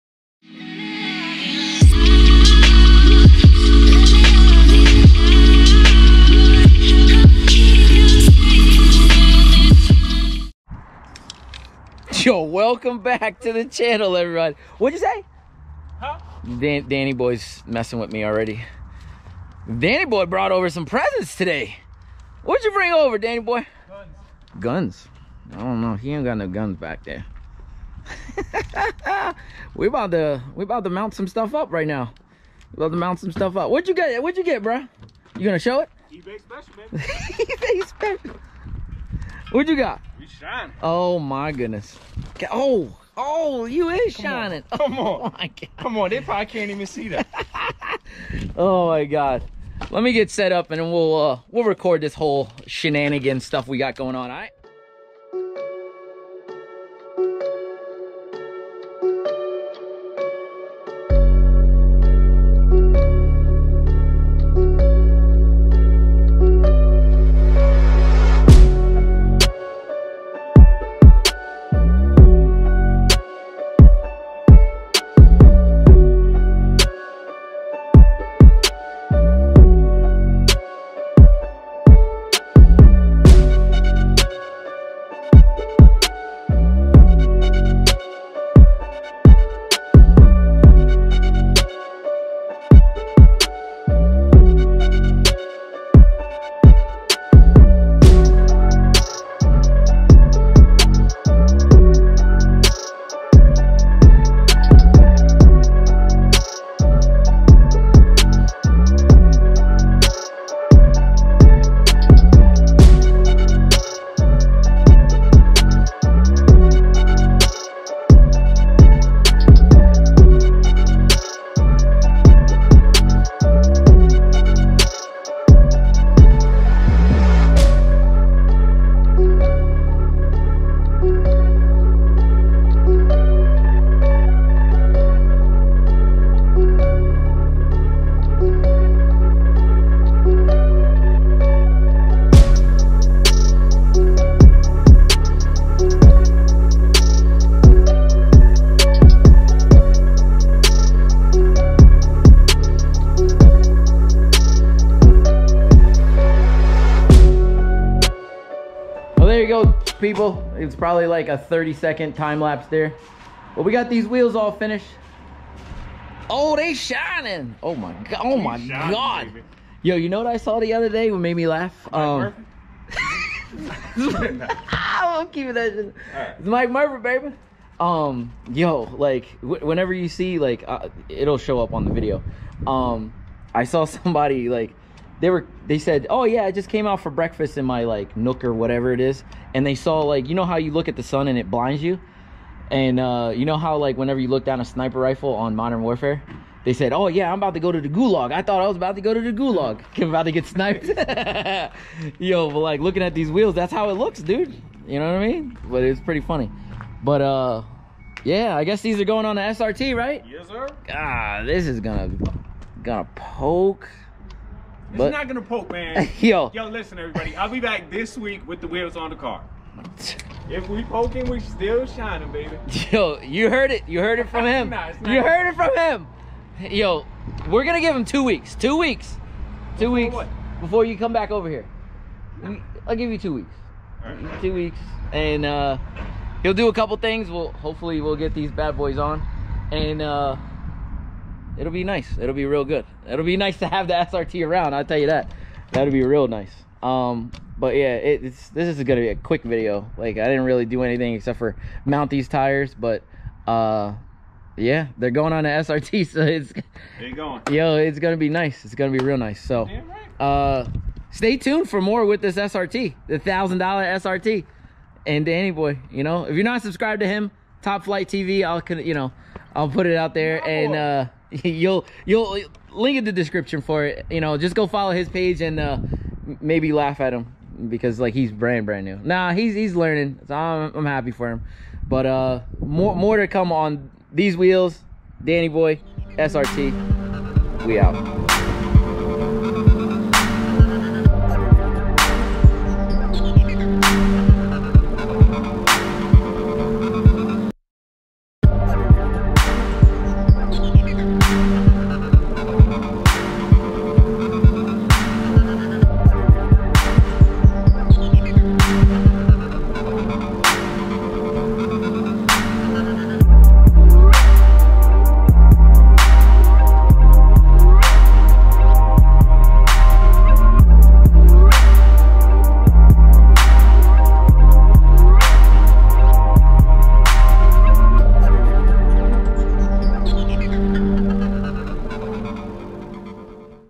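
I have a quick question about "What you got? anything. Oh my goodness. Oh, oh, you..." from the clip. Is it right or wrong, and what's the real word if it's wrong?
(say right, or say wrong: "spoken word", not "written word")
wrong: "shining", not "anything".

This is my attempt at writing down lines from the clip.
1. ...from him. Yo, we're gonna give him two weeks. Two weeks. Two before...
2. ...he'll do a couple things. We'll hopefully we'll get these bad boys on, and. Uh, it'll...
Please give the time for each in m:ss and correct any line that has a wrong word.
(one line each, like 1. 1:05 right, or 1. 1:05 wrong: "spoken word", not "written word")
1. 3:45 right
2. 3:56 right.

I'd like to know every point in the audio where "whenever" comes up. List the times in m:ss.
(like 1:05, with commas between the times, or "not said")
2:59, 3:13.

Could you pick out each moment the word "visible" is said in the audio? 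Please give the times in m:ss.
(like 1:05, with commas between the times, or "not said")
not said.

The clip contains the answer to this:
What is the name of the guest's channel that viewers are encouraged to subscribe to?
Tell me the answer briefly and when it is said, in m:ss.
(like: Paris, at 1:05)
Top Flight TV, at 4:27.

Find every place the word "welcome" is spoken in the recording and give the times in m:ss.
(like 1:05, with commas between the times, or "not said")
0:12.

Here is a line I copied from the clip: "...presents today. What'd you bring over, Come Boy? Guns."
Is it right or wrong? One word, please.
wrong.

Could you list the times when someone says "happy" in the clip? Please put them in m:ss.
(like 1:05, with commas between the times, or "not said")
4:40.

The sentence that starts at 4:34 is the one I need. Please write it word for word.
You know, just go follow his page and uh, maybe laugh at him because like he's brand brand new.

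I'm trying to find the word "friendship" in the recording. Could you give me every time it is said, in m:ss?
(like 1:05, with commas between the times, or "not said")
not said.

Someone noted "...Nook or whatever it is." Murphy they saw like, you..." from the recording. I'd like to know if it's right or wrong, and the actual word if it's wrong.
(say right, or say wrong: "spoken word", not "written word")
wrong: "And", not "Murphy".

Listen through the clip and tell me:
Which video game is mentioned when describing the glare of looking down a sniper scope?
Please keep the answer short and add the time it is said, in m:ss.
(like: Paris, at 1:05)
Modern Warfare, at 3:15.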